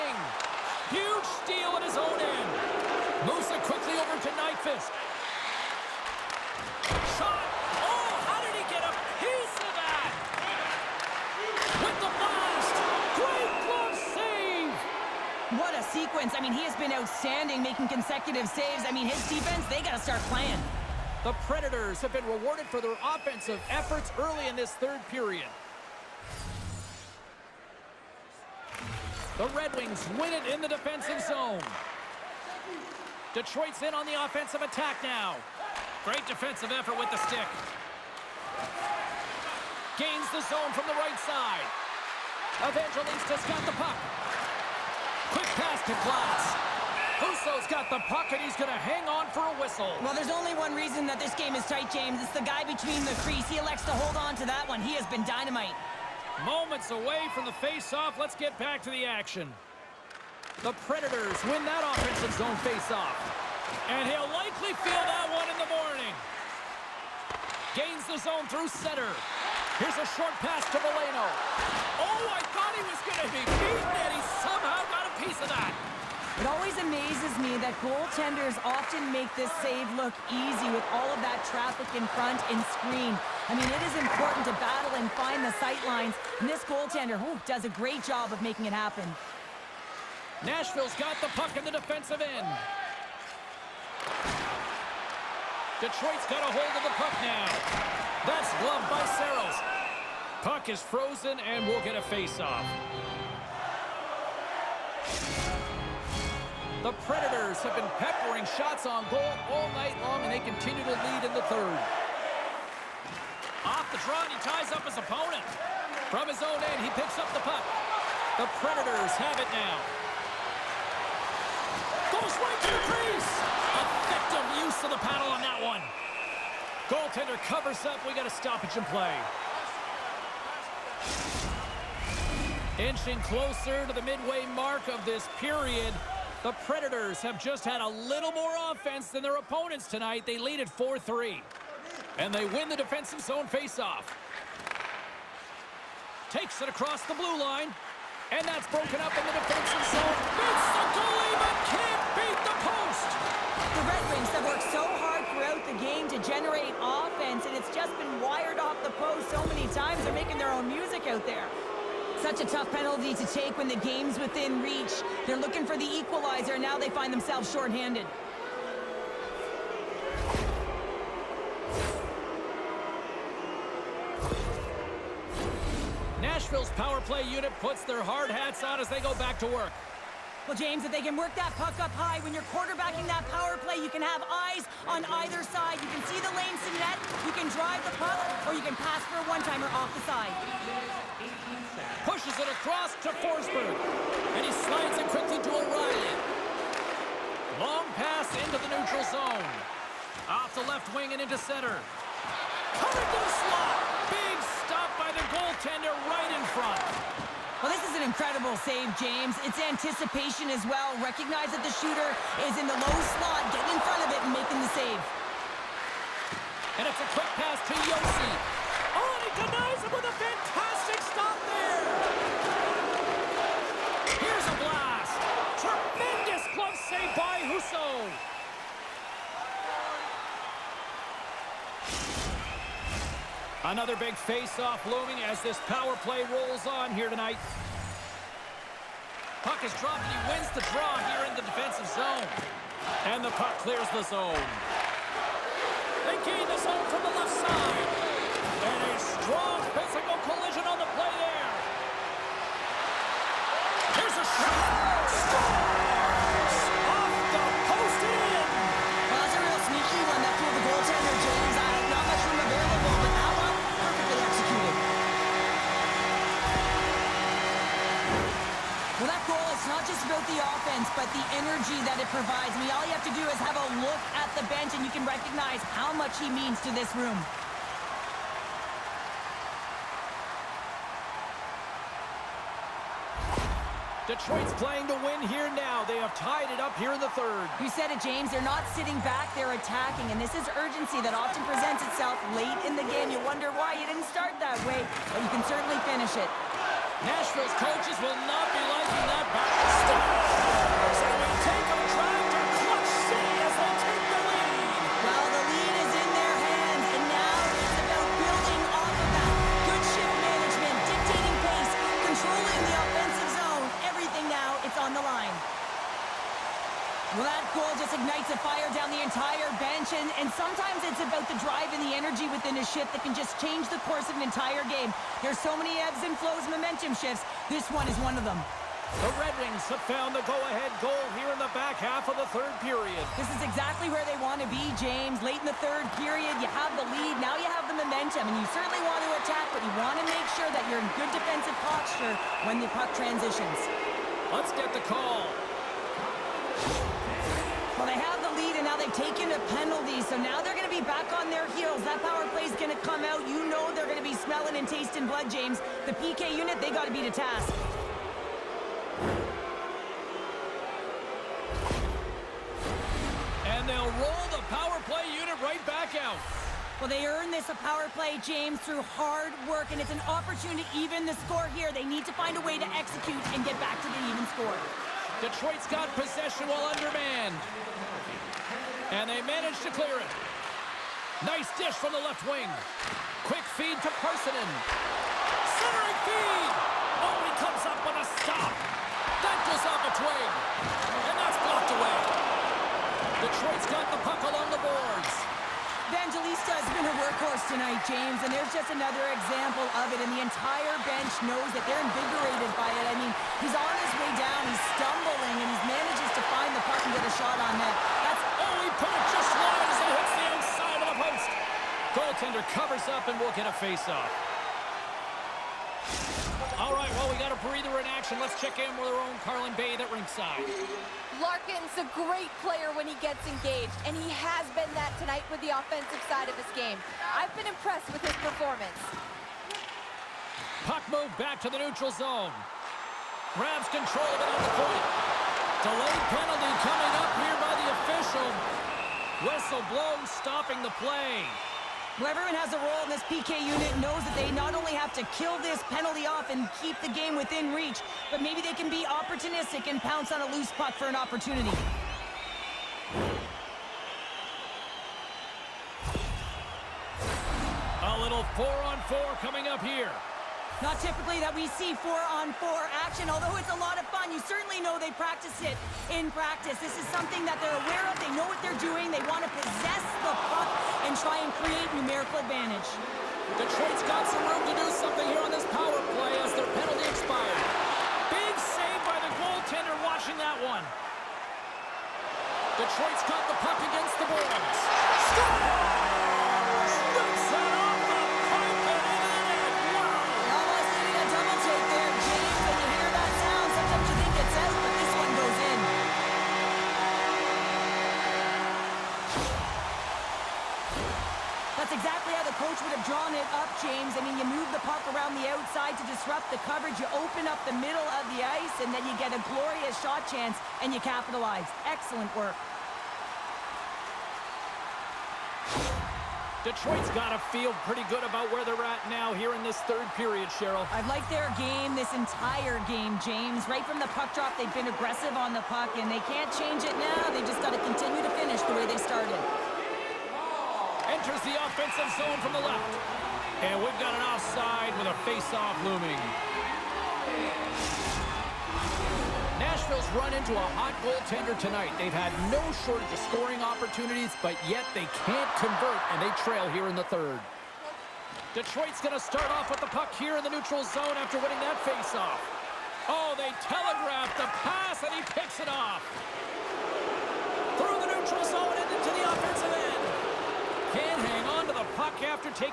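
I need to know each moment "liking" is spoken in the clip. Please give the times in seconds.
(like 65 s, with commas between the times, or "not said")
298 s.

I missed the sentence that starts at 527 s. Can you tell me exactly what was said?
They just got to continue to finish the way they started.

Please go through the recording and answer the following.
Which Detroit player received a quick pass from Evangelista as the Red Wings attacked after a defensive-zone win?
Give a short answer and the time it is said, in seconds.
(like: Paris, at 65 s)
Glass, at 46 s.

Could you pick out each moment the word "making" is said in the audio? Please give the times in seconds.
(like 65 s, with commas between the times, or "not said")
17 s, 88 s, 160 s, 214 s.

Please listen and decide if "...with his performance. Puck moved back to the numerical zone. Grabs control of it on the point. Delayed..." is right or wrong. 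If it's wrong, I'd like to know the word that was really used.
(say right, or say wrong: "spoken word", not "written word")
wrong: "neutral", not "numerical".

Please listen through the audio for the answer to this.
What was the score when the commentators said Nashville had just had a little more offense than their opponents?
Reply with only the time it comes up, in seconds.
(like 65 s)
140 s.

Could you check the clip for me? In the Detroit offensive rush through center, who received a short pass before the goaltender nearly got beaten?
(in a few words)
Veleno.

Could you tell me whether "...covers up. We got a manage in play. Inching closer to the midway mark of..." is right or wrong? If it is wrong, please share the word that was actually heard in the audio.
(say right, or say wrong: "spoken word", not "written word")
wrong: "stoppage", not "manage".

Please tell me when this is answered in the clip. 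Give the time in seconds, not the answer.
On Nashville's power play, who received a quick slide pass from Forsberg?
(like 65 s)
195 s.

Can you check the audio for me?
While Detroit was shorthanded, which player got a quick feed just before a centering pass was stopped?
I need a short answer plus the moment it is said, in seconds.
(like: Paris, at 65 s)
Parssinen, at 383 s.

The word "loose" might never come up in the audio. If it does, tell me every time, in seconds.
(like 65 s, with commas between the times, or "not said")
450 s.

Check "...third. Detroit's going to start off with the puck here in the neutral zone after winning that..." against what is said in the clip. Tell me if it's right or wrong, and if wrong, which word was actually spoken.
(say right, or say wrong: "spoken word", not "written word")
right.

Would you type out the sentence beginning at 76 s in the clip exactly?
It always amazes me that goaltenders often make this save look easy with all of that traffic in front and screen.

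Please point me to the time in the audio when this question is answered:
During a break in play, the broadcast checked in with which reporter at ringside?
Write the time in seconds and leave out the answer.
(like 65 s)
419 s.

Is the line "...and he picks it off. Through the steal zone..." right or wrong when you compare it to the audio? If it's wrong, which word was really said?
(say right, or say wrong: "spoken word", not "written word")
wrong: "neutral", not "steal".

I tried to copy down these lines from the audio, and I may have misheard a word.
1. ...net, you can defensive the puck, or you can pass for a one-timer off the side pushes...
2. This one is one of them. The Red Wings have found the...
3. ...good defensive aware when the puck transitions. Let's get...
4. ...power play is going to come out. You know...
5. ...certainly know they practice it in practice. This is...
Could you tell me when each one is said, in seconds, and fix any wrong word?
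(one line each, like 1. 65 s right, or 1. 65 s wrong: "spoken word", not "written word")
1. 186 s wrong: "drive", not "defensive"
2. 327 s right
3. 340 s wrong: "posture", not "aware"
4. 352 s right
5. 464 s right.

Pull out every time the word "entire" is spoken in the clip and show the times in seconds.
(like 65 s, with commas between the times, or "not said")
318 s, 324 s, 400 s, 521 s.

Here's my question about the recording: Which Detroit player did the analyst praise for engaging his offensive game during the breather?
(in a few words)
Larkin.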